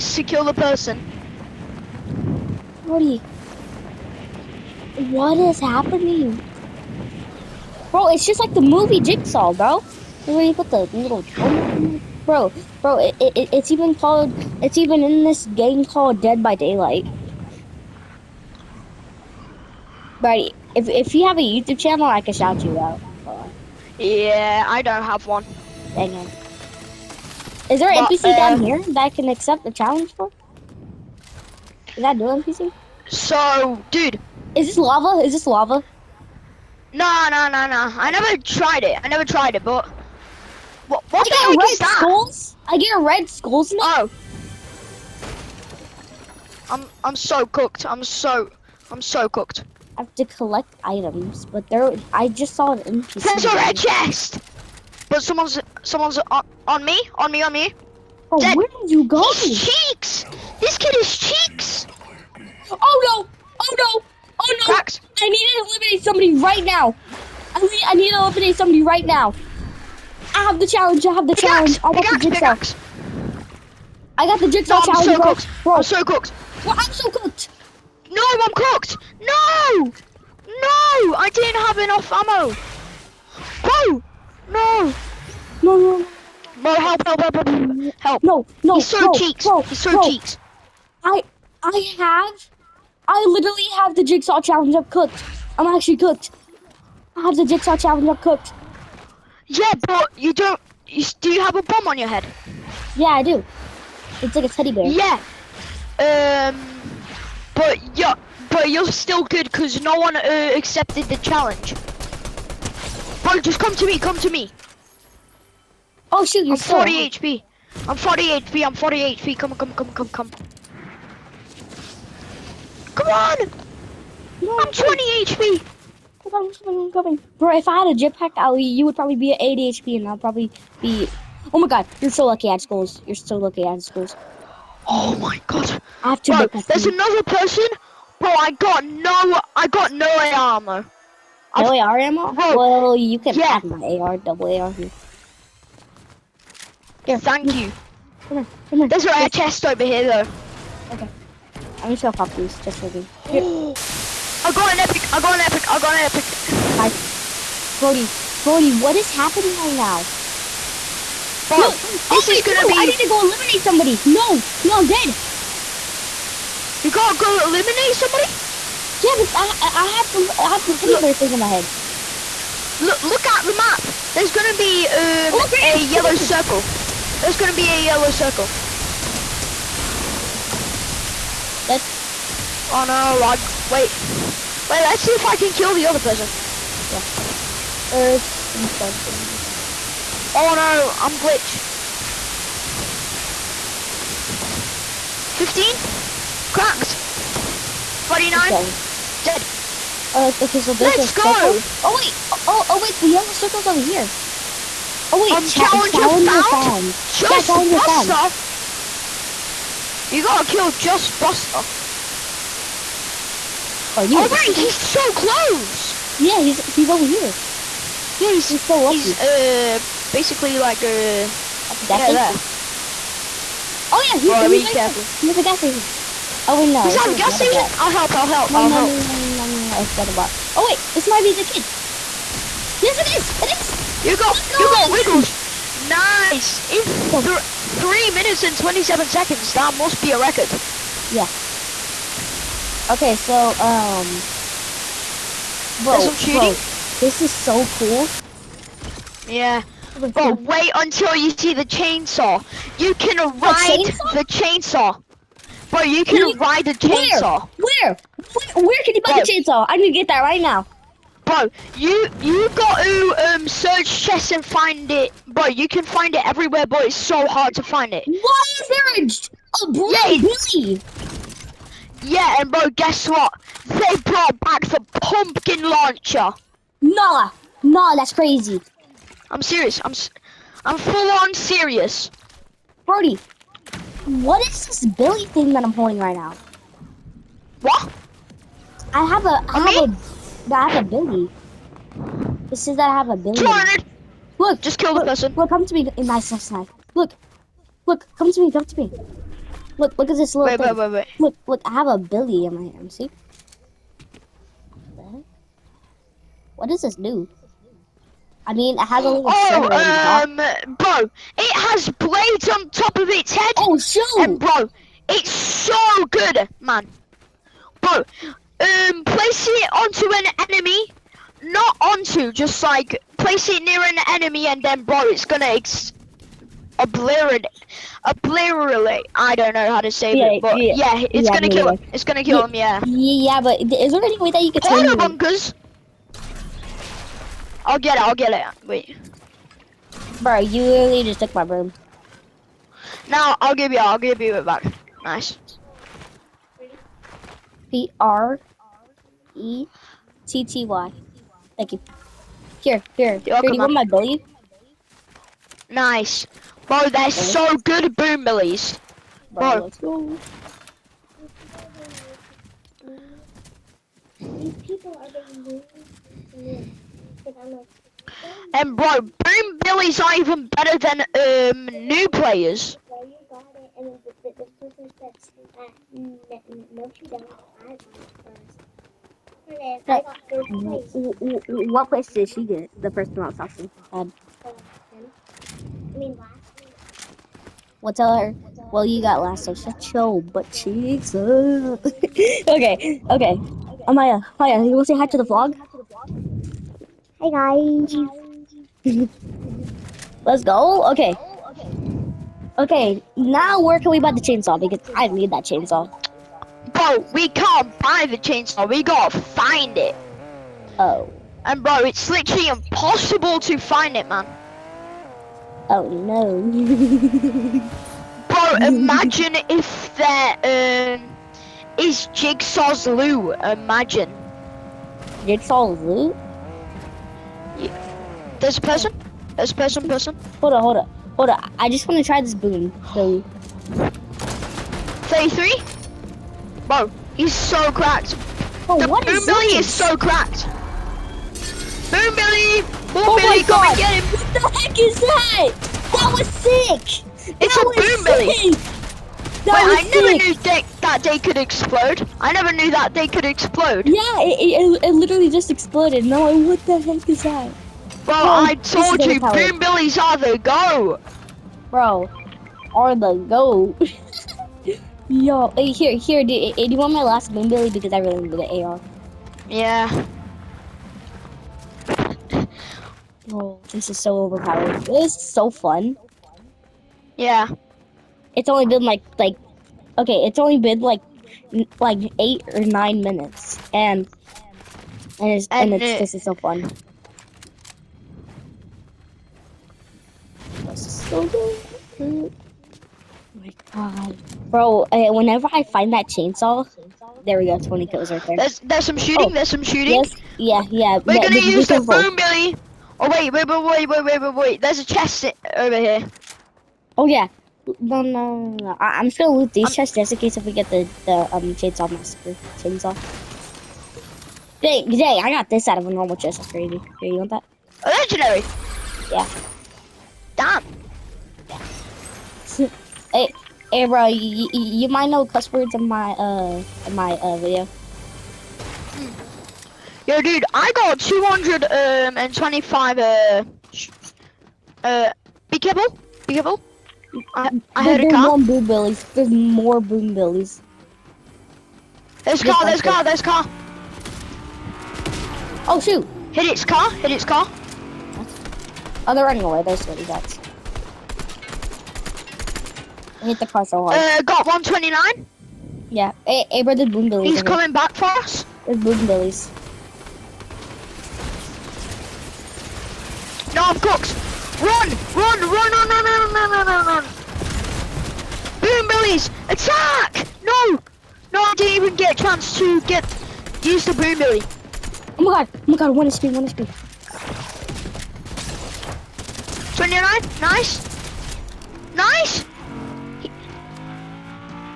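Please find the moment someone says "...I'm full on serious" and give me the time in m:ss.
4:40.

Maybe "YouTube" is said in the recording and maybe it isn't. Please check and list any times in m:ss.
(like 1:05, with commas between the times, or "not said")
0:21.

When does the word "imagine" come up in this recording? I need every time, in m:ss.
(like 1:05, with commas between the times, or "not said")
6:58, 7:03.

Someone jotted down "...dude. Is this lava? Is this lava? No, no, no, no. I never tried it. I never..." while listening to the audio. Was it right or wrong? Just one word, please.
right.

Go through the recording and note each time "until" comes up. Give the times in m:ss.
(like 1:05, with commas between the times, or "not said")
4:10.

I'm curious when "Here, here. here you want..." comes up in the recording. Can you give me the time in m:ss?
5:52.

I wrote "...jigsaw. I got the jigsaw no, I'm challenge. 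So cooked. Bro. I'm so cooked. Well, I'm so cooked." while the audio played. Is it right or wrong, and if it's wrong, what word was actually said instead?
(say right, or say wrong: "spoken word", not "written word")
right.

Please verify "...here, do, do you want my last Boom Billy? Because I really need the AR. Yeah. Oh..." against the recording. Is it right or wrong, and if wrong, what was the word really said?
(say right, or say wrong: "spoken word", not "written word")
right.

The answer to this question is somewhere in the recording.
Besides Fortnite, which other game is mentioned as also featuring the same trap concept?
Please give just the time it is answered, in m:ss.
0:16.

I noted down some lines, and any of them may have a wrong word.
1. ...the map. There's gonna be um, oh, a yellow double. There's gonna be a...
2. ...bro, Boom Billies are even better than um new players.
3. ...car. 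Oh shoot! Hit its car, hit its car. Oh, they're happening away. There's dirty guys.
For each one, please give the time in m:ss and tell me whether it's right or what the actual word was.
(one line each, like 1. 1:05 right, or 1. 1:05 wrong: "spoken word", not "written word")
1. 2:53 wrong: "circle", not "double"
2. 6:08 right
3. 9:03 wrong: "running", not "happening".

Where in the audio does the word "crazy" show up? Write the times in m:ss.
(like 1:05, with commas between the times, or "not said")
4:38, 8:36.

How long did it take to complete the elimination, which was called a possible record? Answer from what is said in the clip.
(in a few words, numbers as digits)
3 minutes and 27 seconds.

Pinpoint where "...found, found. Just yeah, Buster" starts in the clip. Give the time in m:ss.
3:26.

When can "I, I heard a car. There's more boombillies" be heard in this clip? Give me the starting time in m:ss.
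8:57.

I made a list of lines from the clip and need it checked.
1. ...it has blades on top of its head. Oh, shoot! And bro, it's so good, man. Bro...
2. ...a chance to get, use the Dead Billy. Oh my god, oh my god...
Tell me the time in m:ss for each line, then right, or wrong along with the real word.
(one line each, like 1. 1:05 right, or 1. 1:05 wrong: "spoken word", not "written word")
1. 5:11 right
2. 9:32 wrong: "Boom", not "Dead".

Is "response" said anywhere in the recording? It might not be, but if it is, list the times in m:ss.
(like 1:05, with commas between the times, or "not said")
not said.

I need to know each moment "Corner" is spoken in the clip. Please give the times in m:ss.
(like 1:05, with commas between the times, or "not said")
5:34.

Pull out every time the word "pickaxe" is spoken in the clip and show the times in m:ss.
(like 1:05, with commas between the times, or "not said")
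1:11.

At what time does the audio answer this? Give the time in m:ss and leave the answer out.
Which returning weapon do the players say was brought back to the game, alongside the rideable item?
4:35.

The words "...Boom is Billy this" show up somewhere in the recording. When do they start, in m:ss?
7:19.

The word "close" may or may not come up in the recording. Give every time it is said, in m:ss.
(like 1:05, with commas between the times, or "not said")
3:35.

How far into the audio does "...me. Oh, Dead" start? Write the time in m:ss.
0:57.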